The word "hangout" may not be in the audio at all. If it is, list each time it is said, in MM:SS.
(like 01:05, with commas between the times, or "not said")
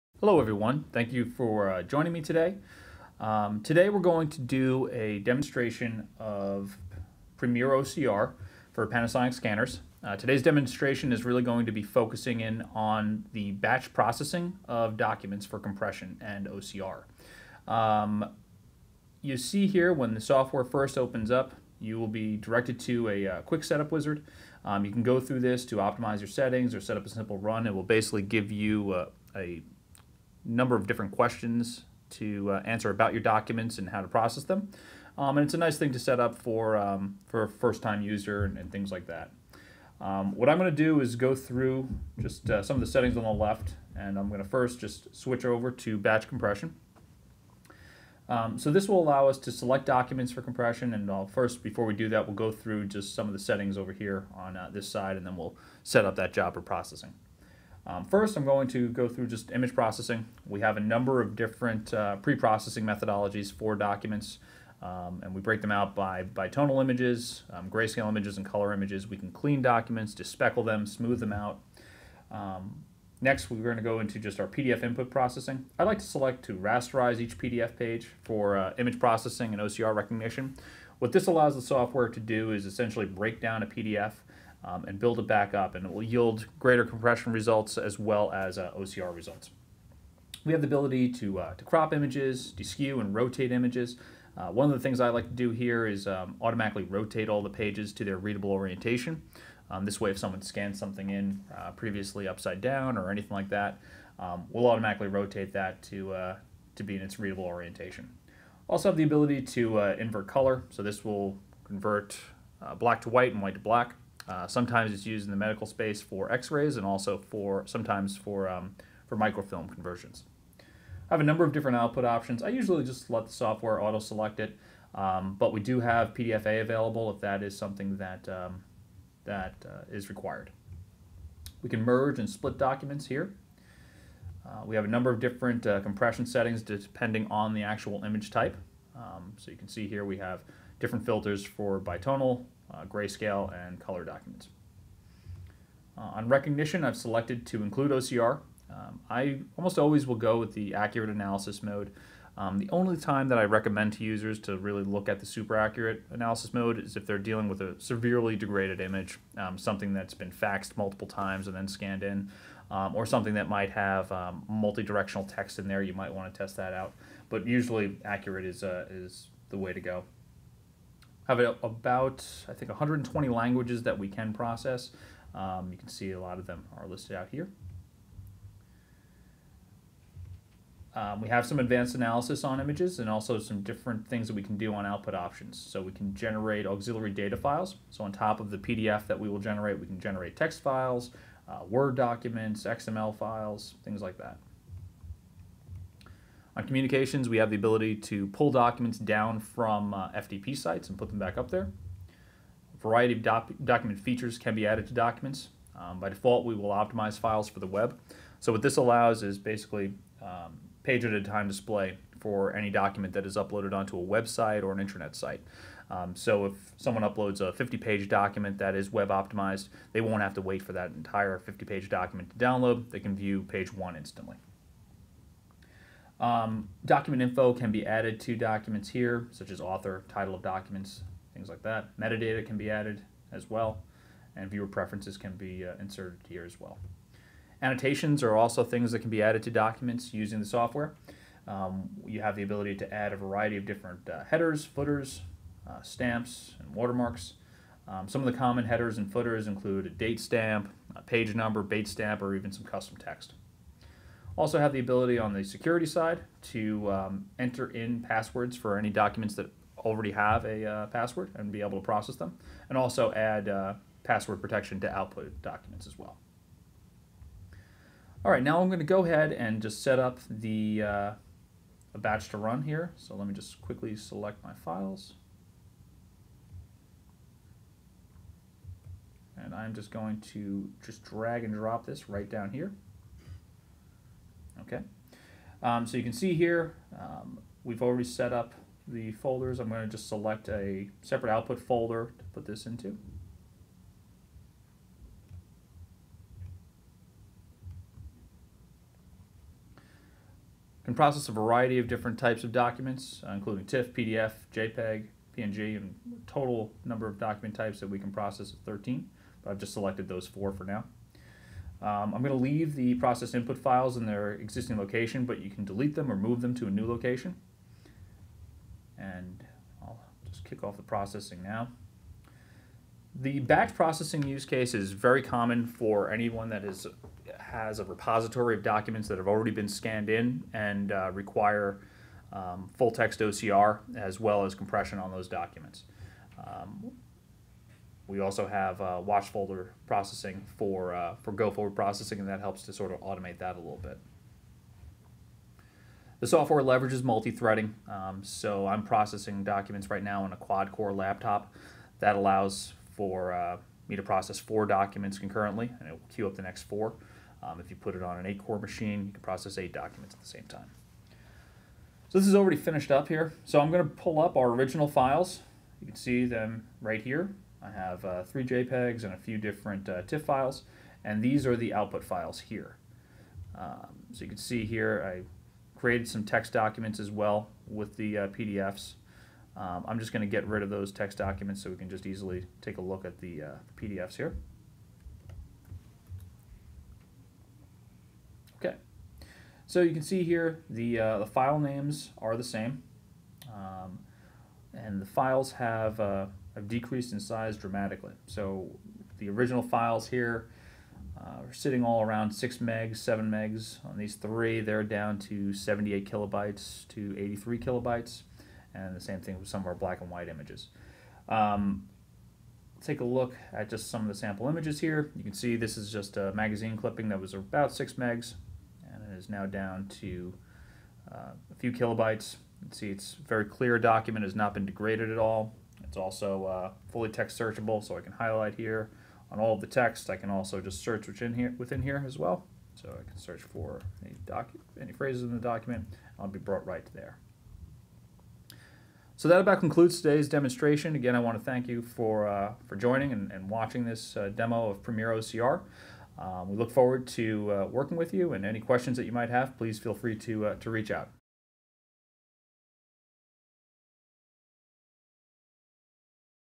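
not said.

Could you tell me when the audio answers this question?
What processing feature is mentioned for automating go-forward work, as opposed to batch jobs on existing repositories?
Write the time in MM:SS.
05:39.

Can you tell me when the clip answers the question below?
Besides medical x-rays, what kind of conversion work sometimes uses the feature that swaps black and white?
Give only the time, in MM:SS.
01:59.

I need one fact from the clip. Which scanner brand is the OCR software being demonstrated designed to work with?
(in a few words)
Panasonic.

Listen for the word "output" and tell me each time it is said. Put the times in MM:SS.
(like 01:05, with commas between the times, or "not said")
02:01, 03:04, 04:24, 04:51, 06:11.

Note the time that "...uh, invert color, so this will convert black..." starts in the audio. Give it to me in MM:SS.
01:49.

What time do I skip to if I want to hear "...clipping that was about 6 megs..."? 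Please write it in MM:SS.
06:56.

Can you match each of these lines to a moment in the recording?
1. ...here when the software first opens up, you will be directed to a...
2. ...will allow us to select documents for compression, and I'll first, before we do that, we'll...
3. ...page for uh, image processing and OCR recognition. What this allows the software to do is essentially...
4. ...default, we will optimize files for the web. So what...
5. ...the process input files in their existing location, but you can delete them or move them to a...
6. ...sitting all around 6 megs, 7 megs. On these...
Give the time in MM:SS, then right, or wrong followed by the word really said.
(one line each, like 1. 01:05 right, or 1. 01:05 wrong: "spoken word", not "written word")
1. 00:19 right
2. 00:48 right
3. 01:17 right
4. 03:26 right
5. 05:12 right
6. 06:41 right.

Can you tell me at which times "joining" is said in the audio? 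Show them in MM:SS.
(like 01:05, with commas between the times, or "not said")
00:01, 07:22.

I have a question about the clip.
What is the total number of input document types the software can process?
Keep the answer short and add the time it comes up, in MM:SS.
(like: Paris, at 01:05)
13, at 05:08.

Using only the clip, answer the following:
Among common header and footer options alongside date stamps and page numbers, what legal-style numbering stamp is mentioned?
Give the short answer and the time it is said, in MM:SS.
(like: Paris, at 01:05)
Bates stamp, at 04:11.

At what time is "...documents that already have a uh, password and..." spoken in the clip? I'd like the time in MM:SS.
04:18.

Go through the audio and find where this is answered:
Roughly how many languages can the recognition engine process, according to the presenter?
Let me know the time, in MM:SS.
02:52.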